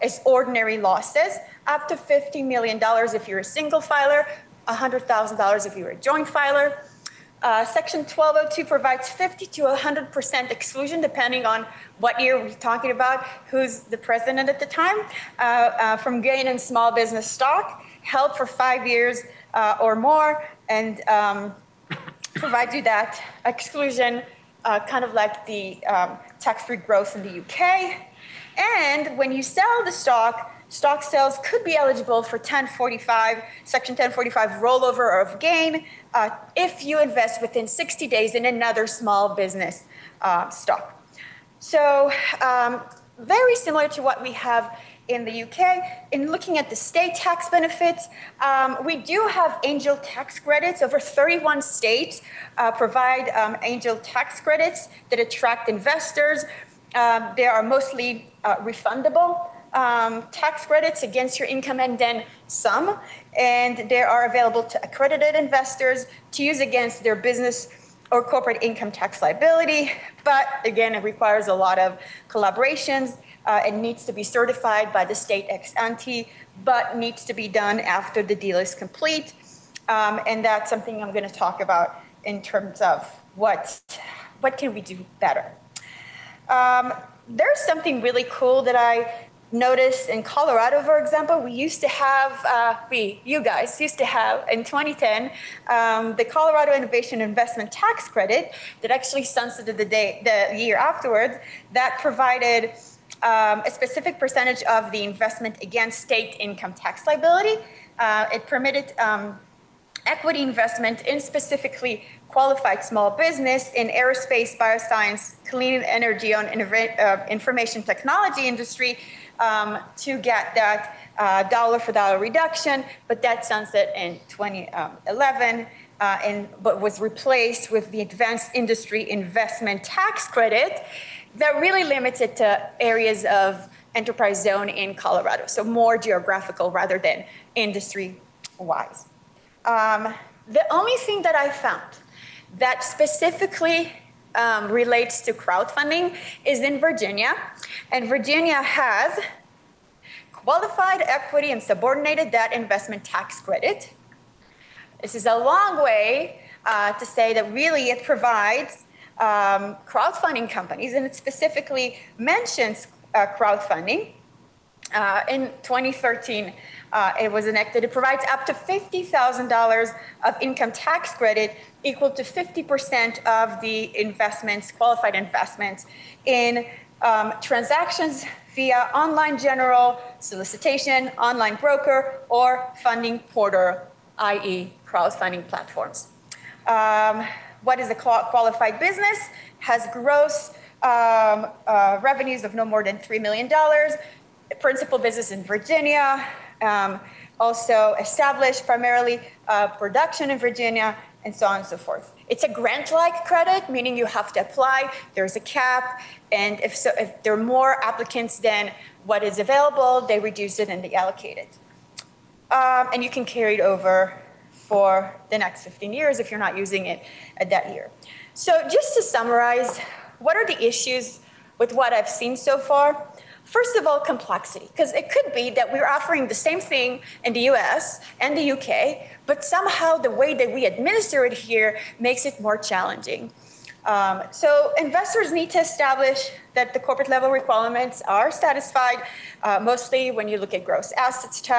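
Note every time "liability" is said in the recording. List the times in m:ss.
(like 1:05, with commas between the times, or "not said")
1:09, 1:47.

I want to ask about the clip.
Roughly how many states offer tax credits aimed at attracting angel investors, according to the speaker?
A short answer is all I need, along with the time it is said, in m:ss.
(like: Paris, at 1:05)
Over 31, at 0:50.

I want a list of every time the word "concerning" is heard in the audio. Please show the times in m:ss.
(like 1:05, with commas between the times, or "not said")
not said.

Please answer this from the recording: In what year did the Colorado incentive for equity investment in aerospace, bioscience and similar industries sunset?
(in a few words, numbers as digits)
2011.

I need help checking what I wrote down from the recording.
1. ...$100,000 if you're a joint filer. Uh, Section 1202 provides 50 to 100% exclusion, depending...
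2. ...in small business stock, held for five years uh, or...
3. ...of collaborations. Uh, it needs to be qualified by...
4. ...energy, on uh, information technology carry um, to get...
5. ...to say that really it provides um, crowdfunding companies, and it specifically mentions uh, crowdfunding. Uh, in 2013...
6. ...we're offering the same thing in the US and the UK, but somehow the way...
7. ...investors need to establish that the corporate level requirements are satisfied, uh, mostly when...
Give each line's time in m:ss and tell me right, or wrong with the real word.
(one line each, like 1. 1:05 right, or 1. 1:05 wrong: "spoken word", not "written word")
1. 0:04 right
2. 0:16 right
3. 1:11 wrong: "certified", not "qualified"
4. 1:55 wrong: "industry", not "carry"
5. 2:36 right
6. 3:45 right
7. 3:54 right.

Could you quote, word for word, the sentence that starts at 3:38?
So just to summarize, what are the issues with what I've seen so far?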